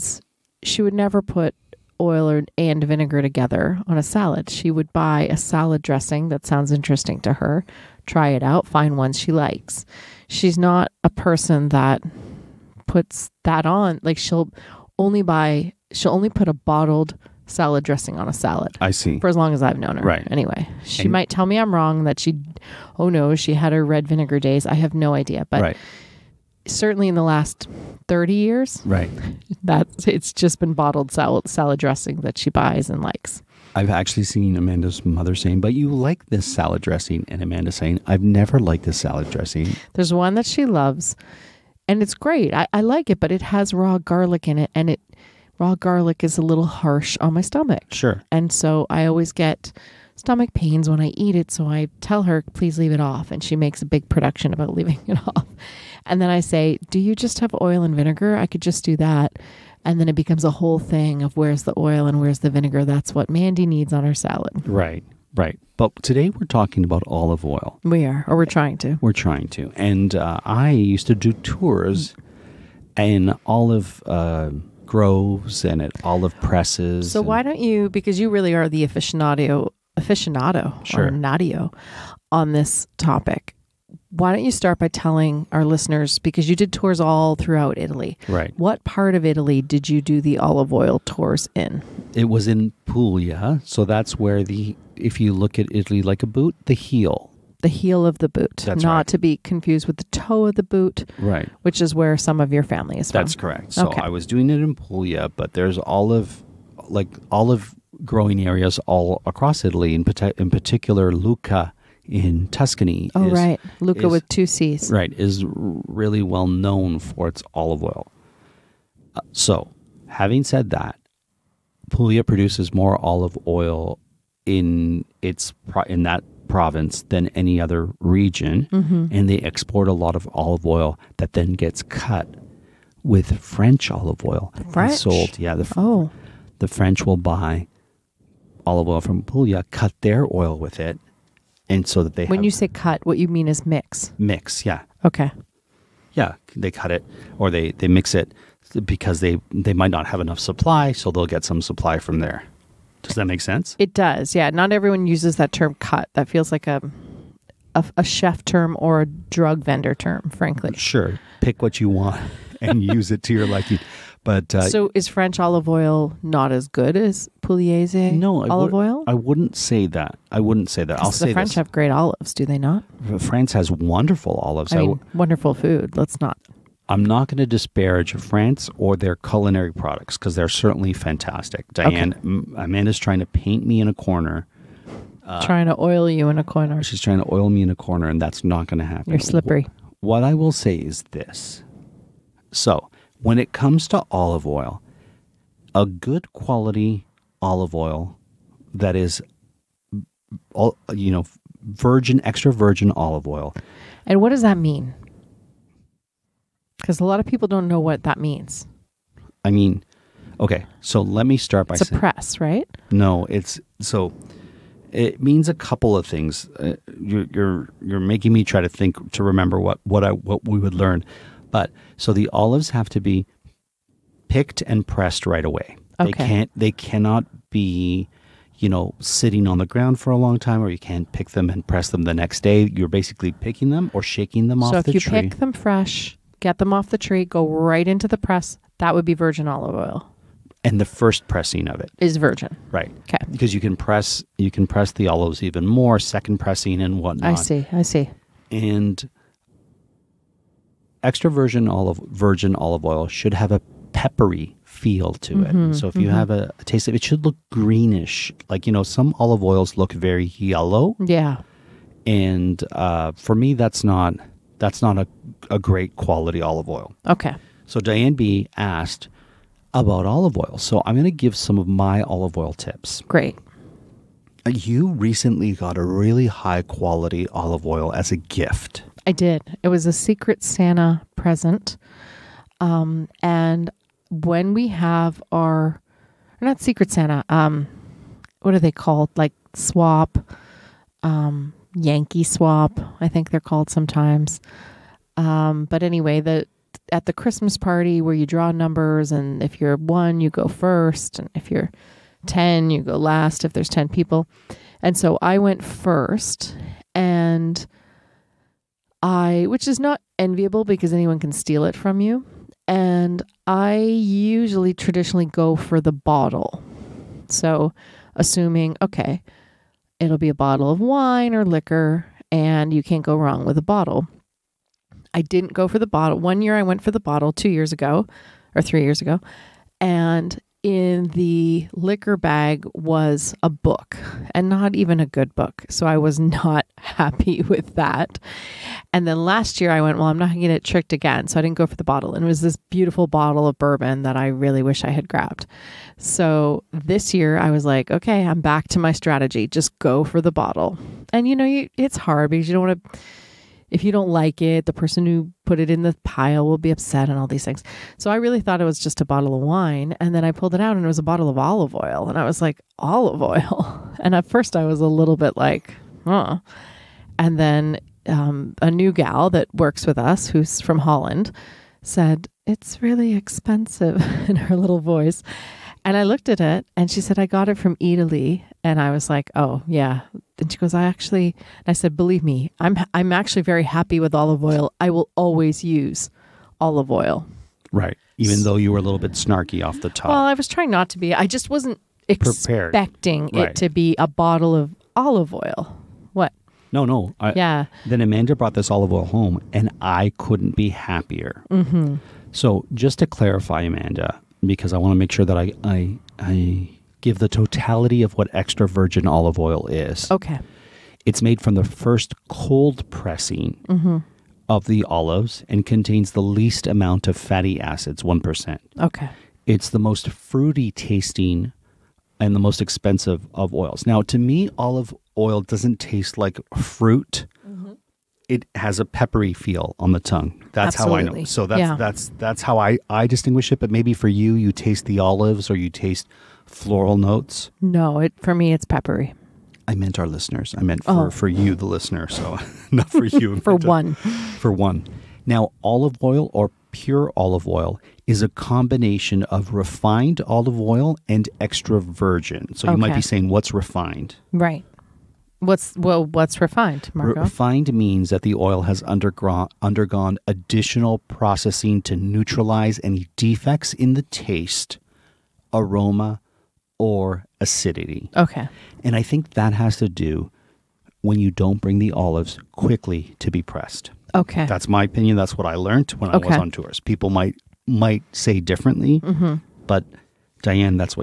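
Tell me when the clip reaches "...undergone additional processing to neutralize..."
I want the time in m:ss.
7:39.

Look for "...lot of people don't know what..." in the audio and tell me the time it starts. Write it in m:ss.
3:27.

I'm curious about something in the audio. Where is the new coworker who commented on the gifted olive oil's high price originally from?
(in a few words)
Holland.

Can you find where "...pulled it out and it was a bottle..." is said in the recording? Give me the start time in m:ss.
6:00.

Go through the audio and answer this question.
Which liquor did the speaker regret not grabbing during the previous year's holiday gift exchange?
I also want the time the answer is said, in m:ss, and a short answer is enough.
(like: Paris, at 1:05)
Bourbon, at 5:42.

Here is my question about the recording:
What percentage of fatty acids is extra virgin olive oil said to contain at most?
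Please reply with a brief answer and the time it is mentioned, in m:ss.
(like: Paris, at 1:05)
1%, at 6:58.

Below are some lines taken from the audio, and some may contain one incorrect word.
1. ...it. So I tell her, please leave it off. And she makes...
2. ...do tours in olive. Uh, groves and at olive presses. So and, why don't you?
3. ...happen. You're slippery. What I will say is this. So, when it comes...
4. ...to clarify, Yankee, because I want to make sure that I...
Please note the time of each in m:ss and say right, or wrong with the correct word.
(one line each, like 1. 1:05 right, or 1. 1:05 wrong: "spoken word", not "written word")
1. 0:51 right
2. 1:11 right
3. 3:08 right
4. 6:43 wrong: "Amanda", not "Yankee".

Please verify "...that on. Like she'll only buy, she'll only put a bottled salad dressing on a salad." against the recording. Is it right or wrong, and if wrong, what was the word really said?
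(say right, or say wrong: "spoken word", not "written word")
right.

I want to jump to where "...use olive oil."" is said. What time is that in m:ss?
6:25.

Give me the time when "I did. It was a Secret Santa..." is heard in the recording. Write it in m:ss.
4:39.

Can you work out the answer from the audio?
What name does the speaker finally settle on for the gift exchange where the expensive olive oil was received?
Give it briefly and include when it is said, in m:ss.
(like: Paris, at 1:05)
Yankee swap, at 4:51.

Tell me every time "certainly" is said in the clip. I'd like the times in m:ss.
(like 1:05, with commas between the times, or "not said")
0:26, 3:00.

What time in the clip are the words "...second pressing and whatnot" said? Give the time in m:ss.
4:05.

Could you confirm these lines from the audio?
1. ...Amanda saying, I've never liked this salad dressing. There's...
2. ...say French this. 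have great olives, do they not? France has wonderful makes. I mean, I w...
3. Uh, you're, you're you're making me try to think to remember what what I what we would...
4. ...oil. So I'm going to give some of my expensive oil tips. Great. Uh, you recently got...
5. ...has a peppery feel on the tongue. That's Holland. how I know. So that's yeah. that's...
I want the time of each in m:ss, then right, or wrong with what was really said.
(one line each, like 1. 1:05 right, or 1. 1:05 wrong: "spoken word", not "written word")
1. 0:37 right
2. 2:51 wrong: "olives", not "makes"
3. 3:36 right
4. 4:30 wrong: "olive", not "expensive"
5. 7:08 wrong: "Absolutely", not "Holland".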